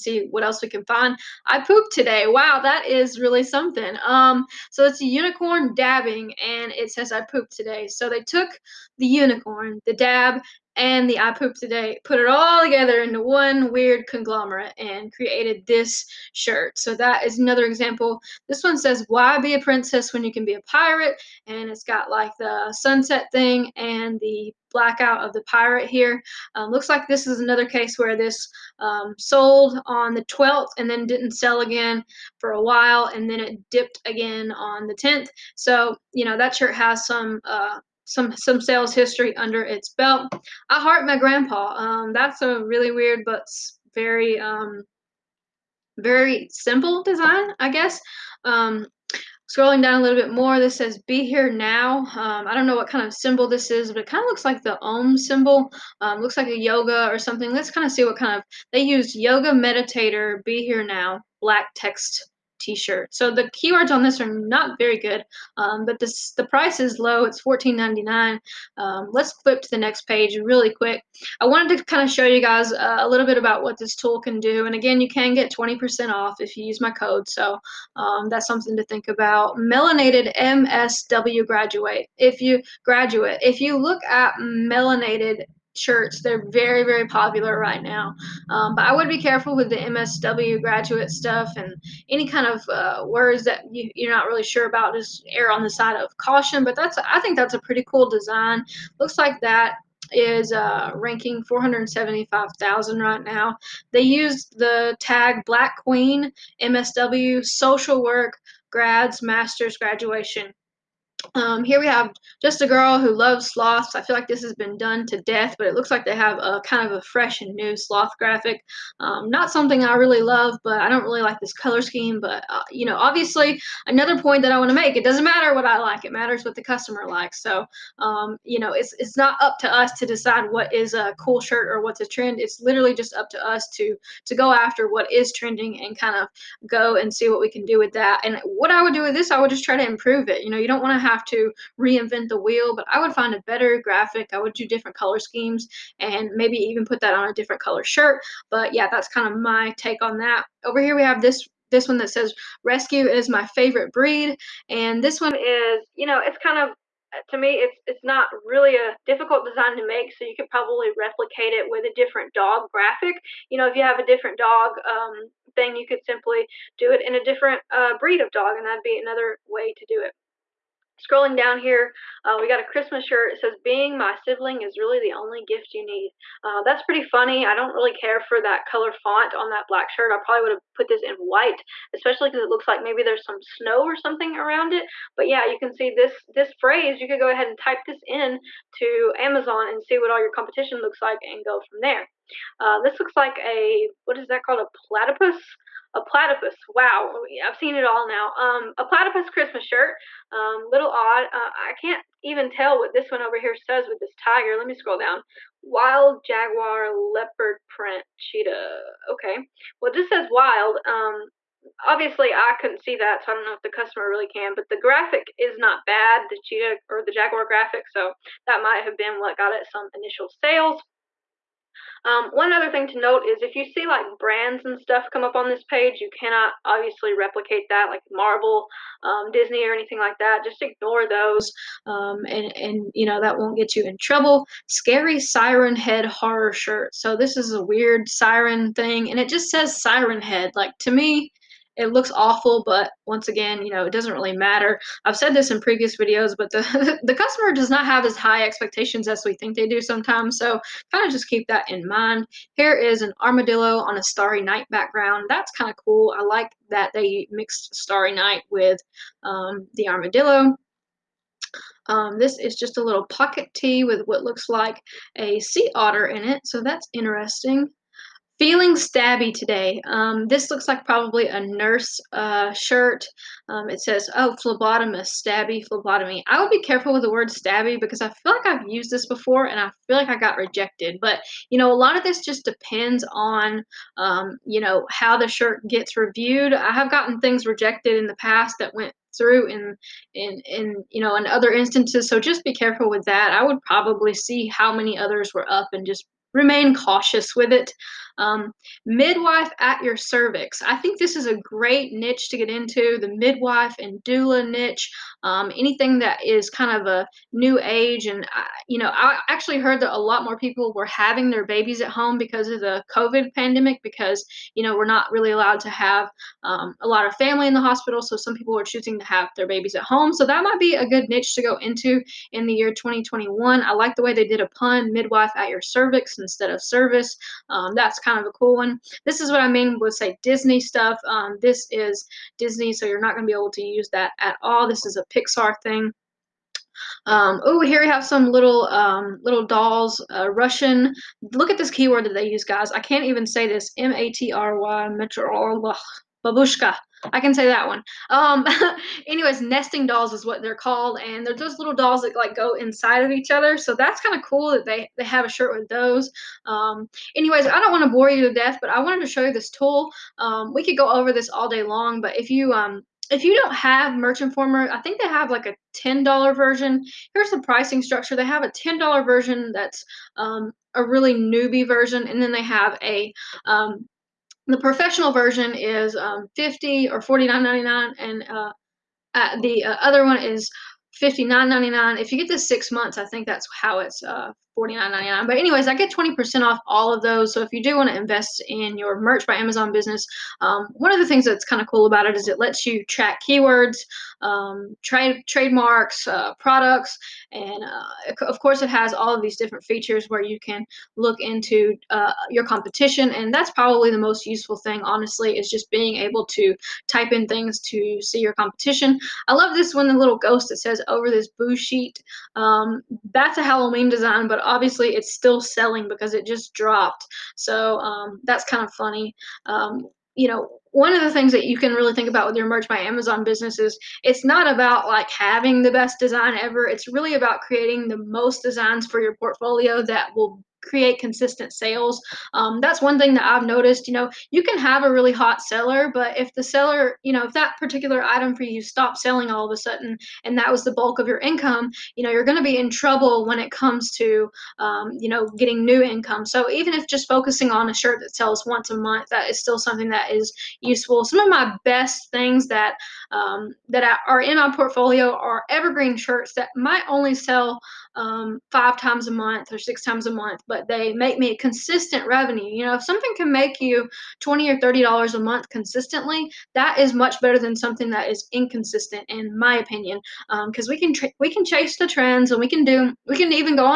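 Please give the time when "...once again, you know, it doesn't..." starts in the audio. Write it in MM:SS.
04:03.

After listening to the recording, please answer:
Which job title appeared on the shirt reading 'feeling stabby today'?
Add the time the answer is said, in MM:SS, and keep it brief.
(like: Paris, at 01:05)
Phlebotomist, at 04:34.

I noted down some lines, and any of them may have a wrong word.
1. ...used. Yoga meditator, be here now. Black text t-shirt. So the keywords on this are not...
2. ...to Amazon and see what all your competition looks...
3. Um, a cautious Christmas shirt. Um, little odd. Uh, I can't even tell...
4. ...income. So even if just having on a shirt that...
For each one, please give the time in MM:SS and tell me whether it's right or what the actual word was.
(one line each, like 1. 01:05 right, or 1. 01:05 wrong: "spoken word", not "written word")
1. 00:58 right
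2. 03:08 right
3. 03:18 wrong: "platypus", not "cautious"
4. 07:25 wrong: "focusing", not "having".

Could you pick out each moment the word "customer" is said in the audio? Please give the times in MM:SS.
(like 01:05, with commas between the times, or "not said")
02:06, 03:33, 04:07.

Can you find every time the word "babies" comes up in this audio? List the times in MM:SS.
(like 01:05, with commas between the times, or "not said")
05:11, 05:19.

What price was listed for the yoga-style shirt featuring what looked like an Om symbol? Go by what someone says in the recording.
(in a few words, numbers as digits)
$14.99.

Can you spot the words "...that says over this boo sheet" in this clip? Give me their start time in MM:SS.
06:50.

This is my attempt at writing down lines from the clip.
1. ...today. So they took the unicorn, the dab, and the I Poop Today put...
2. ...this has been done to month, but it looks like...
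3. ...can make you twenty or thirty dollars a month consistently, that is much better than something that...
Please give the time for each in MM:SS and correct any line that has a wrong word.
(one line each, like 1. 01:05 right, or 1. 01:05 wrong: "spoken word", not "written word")
1. 00:07 right
2. 01:54 wrong: "death", not "month"
3. 07:43 right.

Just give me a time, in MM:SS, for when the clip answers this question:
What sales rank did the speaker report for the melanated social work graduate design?
01:41.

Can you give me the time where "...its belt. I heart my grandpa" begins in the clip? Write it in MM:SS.
00:39.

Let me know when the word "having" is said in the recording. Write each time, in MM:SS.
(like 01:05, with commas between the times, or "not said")
05:10, 07:05.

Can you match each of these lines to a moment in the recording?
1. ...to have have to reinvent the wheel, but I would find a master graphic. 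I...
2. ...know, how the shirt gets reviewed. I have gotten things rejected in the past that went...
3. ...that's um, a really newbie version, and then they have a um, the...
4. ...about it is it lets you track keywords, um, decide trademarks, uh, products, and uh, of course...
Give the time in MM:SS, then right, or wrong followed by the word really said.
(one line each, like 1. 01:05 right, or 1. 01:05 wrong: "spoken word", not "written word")
1. 02:20 wrong: "better", not "master"
2. 04:44 right
3. 06:09 right
4. 06:31 wrong: "trade", not "decide".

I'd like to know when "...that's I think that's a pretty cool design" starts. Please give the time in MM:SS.
01:36.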